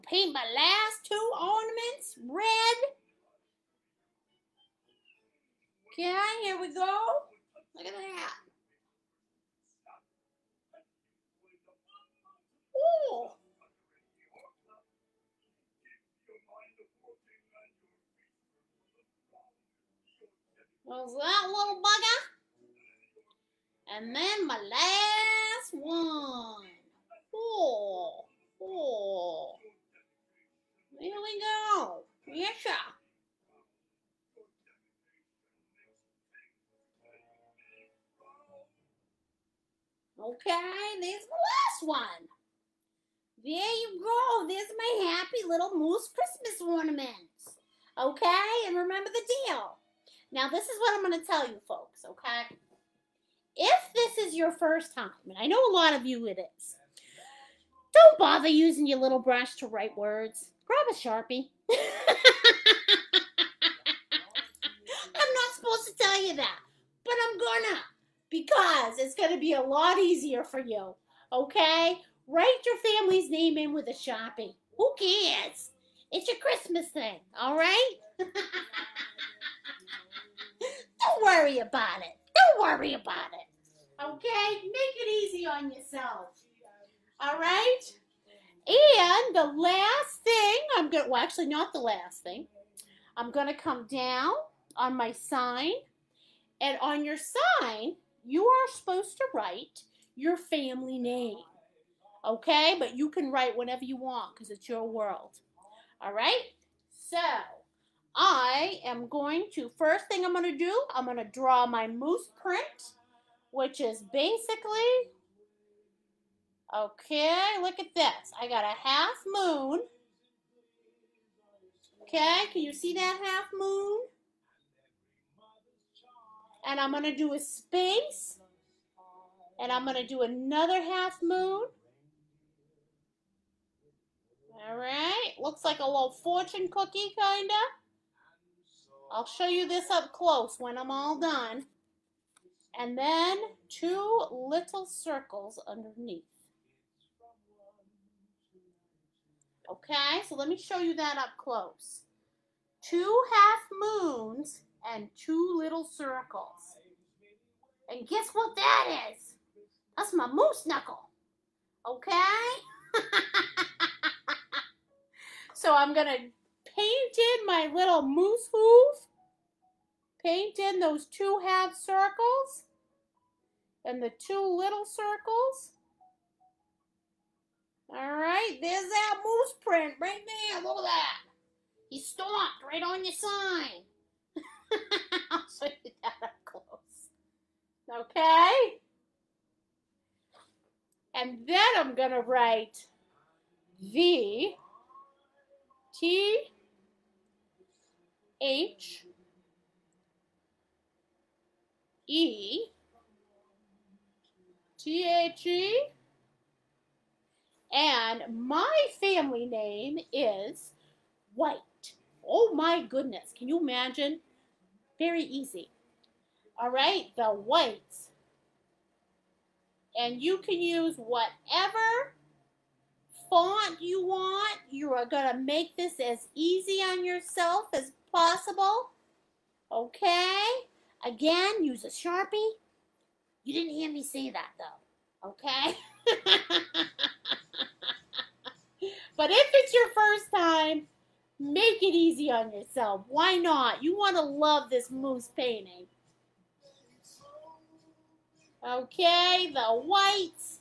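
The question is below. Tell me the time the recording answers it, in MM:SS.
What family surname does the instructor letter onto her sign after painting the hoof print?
03:31.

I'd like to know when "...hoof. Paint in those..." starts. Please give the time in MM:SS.
02:48.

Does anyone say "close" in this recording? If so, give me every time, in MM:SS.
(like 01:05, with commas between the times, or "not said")
02:20, 02:31, 03:06.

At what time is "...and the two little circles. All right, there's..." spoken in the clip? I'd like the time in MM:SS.
02:53.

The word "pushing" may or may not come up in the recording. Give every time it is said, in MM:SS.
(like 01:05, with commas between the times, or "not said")
not said.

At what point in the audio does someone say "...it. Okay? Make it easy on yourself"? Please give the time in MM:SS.
01:23.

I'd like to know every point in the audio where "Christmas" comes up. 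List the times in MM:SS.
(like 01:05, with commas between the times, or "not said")
00:46, 01:16.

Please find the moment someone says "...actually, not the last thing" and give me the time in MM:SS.
01:31.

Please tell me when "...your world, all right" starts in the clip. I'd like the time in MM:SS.
01:44.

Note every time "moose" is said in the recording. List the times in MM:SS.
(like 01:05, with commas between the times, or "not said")
00:45, 01:51, 02:40, 02:48, 02:59, 04:04.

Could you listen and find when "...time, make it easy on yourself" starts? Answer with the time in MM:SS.
04:00.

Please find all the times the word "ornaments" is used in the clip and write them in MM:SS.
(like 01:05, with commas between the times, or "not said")
00:01, 00:46.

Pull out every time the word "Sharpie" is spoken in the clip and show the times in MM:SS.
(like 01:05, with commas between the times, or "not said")
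01:00, 01:13, 03:51.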